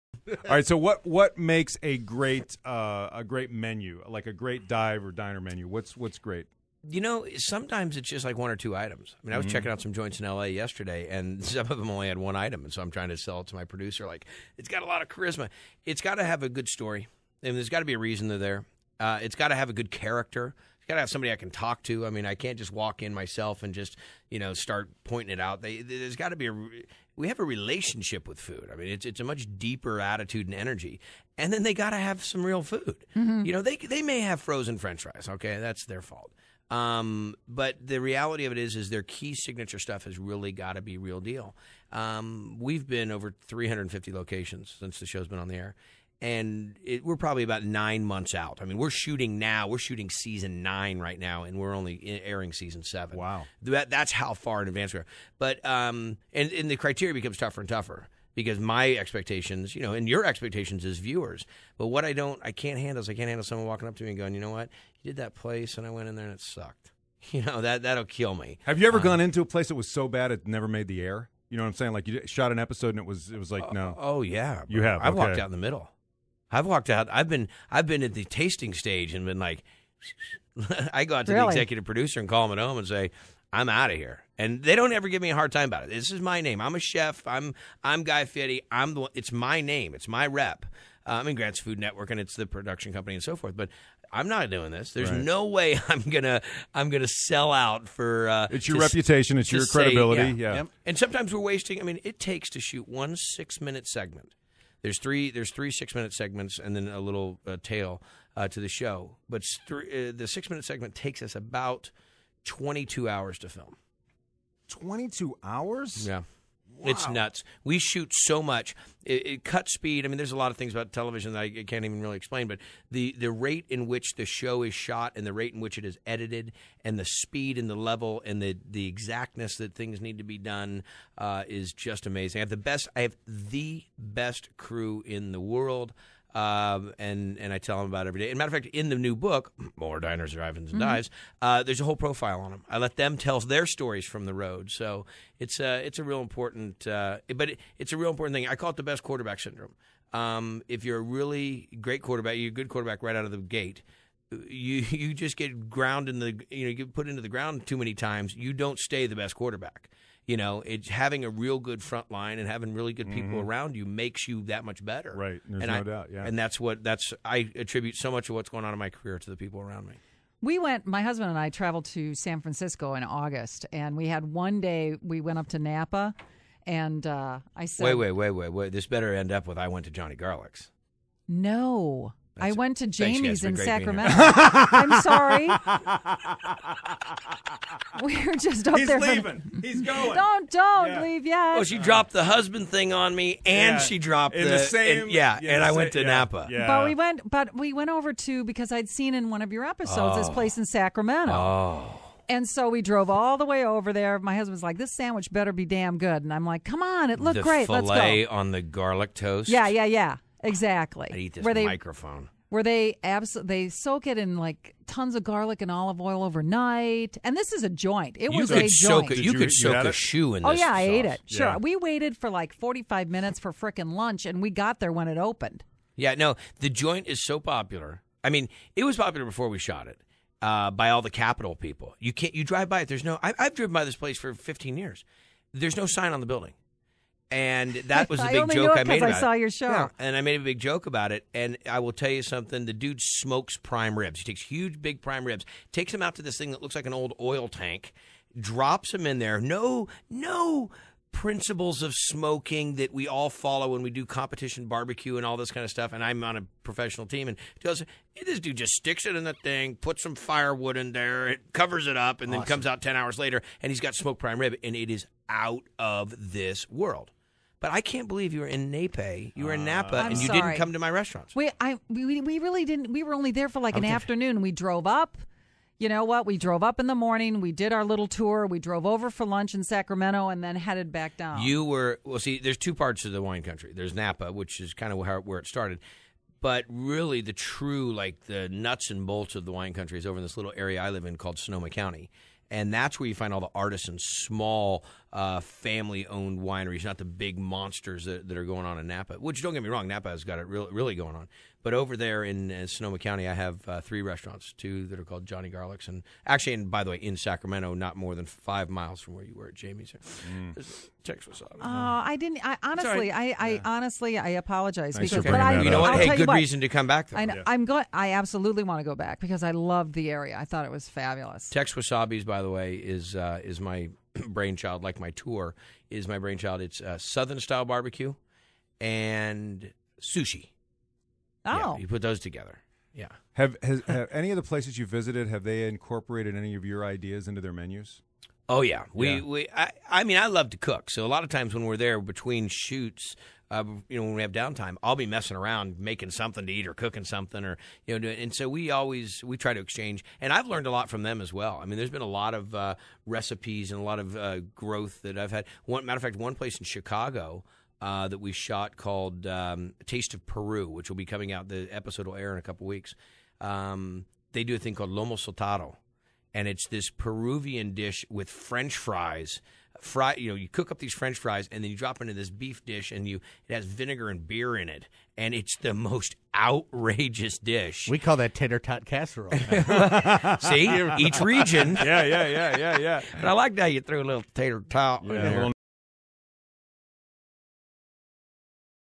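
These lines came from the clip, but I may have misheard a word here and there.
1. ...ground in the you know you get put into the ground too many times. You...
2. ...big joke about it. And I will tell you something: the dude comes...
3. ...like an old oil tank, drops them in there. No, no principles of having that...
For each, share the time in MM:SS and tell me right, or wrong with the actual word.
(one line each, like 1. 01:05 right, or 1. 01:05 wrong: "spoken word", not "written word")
1. 02:35 right
2. 04:00 wrong: "smokes", not "comes"
3. 04:06 wrong: "smoking", not "having".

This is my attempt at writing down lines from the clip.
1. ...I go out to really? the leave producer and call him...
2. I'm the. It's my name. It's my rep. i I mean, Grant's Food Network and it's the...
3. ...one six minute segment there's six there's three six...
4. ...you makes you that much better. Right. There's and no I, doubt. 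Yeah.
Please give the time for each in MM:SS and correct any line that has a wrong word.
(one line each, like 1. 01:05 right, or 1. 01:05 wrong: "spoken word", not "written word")
1. 01:20 wrong: "executive", not "leave"
2. 01:28 right
3. 01:42 wrong: "three", not "six"
4. 02:43 right.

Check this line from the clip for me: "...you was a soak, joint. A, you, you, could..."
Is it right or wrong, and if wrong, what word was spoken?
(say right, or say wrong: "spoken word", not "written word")
right.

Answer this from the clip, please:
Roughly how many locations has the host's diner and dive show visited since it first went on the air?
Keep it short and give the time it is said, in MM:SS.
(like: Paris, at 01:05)
over 350, at 00:43.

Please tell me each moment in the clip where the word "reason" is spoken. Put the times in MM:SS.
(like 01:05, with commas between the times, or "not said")
00:17, 05:16.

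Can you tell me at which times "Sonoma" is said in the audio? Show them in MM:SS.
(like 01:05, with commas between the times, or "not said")
04:51, 05:02.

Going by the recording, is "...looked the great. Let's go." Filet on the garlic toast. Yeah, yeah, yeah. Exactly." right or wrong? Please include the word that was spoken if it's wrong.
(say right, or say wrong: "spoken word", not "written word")
right.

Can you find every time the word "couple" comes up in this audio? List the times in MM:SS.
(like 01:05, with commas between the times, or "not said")
06:02.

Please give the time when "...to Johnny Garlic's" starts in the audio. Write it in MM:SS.
02:59.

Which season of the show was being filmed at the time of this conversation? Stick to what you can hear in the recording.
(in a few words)
season 9.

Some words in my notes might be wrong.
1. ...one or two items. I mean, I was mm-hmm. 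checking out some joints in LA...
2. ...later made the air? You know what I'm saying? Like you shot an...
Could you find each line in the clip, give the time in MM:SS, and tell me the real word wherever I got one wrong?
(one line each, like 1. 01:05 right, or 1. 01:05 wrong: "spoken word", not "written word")
1. 00:08 right
2. 01:10 wrong: "never", not "later".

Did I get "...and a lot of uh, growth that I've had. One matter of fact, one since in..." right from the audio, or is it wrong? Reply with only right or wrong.
wrong.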